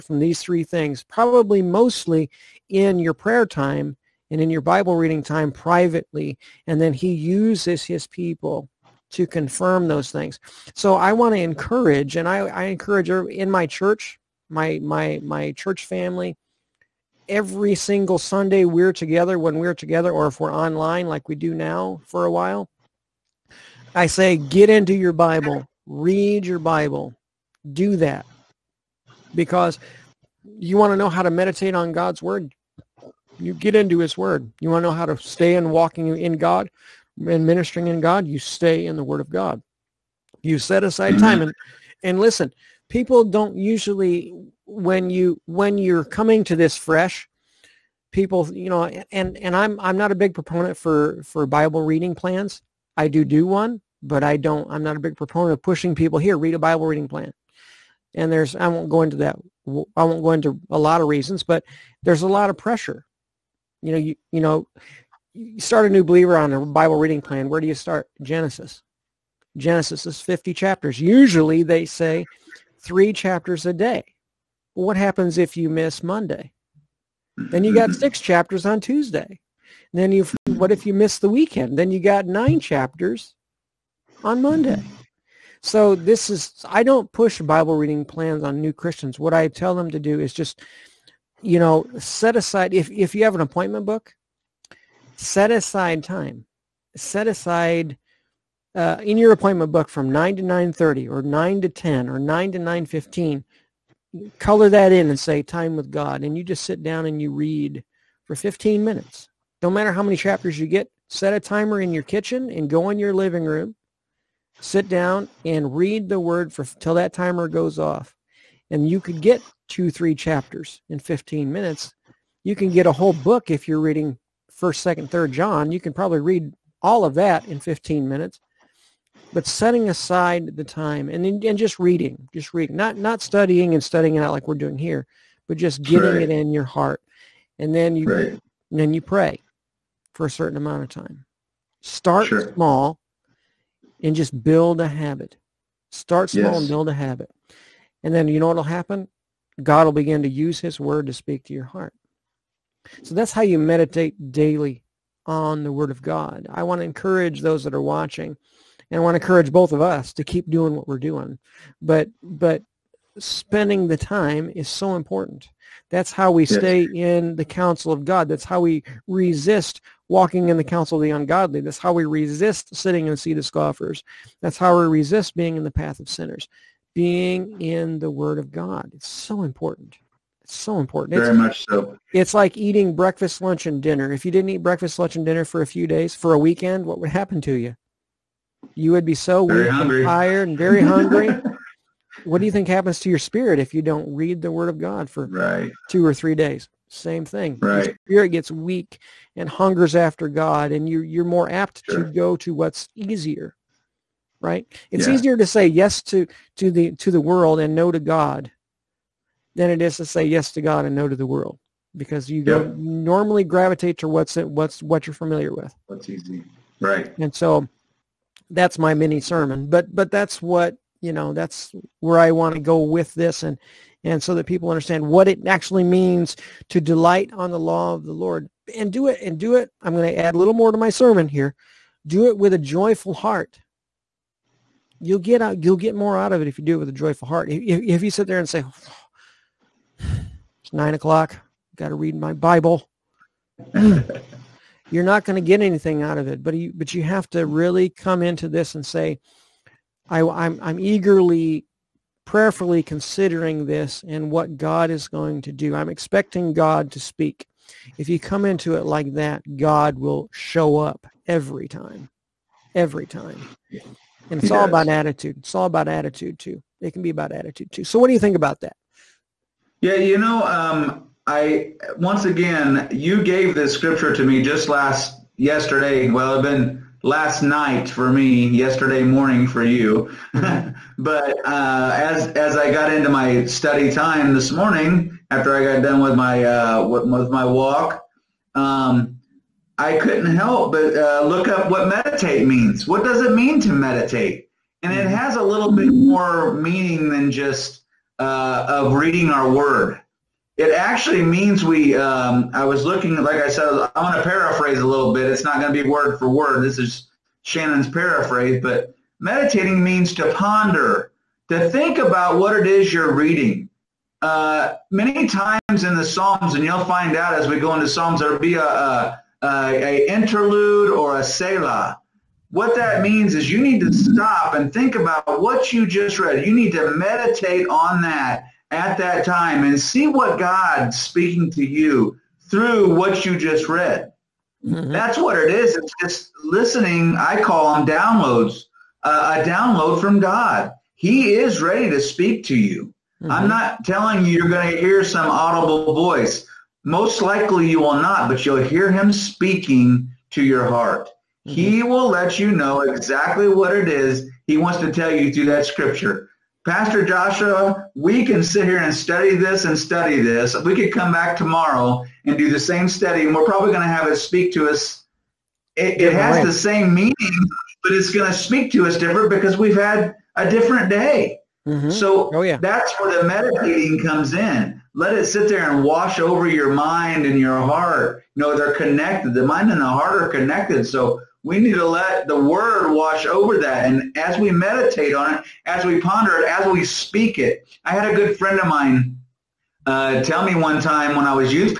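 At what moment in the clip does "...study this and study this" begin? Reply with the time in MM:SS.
05:58.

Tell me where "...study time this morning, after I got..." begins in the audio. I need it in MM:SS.
04:43.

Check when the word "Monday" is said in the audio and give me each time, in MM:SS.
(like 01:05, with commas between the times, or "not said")
01:16, 01:24.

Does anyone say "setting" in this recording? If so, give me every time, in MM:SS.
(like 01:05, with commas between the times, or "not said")
02:09.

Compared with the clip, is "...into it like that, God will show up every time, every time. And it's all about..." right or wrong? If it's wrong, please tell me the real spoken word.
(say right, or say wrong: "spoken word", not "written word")
right.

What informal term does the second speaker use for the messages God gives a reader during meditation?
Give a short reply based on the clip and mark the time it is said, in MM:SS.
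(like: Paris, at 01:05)
Downloads, at 05:37.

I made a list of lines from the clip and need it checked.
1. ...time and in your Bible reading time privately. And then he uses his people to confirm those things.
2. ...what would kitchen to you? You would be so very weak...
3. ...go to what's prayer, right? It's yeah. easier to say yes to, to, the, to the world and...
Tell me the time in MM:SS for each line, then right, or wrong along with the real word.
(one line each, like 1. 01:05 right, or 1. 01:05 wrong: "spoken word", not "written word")
1. 00:03 right
2. 03:06 wrong: "happen", not "kitchen"
3. 03:22 wrong: "easier", not "prayer".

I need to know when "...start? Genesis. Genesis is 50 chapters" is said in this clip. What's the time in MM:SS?
01:07.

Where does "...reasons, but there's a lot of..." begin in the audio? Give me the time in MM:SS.
01:01.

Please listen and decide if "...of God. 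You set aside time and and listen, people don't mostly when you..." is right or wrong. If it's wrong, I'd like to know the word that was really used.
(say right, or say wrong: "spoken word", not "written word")
wrong: "usually", not "mostly".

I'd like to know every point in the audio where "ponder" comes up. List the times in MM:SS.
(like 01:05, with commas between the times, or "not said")
05:10, 06:25.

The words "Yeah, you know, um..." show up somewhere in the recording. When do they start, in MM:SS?
04:29.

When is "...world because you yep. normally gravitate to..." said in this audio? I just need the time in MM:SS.
03:31.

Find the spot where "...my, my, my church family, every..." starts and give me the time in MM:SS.
00:14.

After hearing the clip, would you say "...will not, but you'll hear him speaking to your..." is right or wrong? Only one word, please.
right.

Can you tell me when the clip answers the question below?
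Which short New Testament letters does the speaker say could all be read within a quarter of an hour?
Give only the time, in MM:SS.
02:04.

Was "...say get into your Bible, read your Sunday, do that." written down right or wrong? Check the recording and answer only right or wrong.
wrong.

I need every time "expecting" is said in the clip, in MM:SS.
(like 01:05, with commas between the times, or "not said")
04:15.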